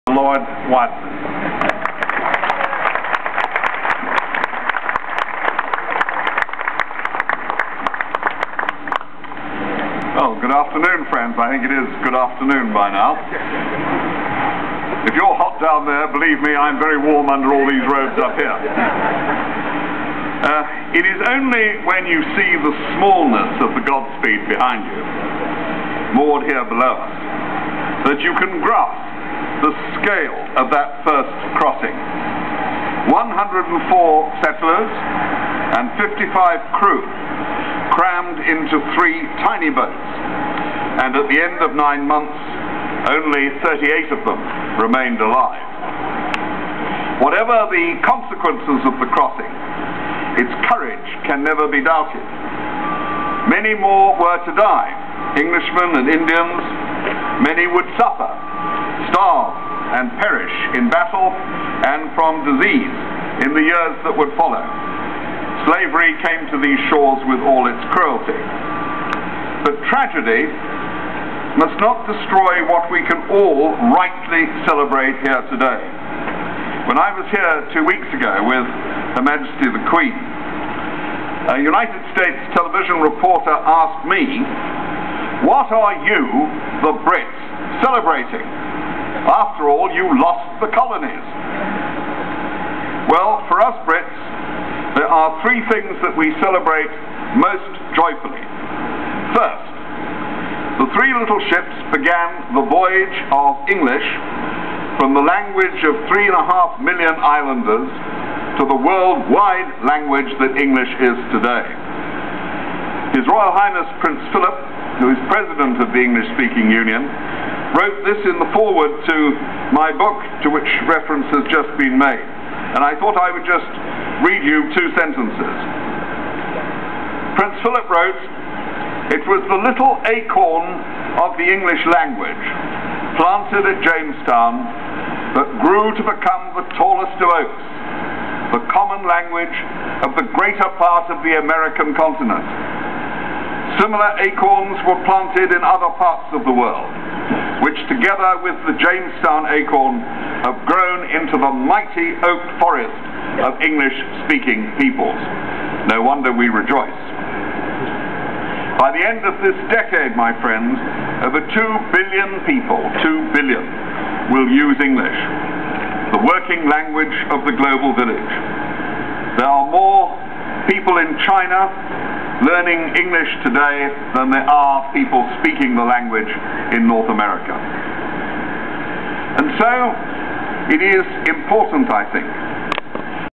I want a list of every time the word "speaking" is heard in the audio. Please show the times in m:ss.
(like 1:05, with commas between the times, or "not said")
1:56, 2:33, 2:55.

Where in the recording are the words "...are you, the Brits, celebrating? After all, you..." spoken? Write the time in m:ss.
1:25.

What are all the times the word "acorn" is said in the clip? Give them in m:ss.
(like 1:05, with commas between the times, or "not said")
2:10, 2:24, 2:29.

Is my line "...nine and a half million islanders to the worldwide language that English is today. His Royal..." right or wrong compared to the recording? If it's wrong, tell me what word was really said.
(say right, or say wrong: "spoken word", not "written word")
wrong: "three", not "nine".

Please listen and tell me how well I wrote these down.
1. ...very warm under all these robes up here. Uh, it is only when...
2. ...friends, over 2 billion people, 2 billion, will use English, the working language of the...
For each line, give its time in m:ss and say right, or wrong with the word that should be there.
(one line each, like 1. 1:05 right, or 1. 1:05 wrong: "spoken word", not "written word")
1. 0:16 right
2. 2:40 right.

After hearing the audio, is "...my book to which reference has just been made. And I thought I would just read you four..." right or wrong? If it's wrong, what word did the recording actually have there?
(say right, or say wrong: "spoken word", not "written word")
wrong: "two", not "four".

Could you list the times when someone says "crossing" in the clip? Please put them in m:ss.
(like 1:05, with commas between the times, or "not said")
0:31, 0:49.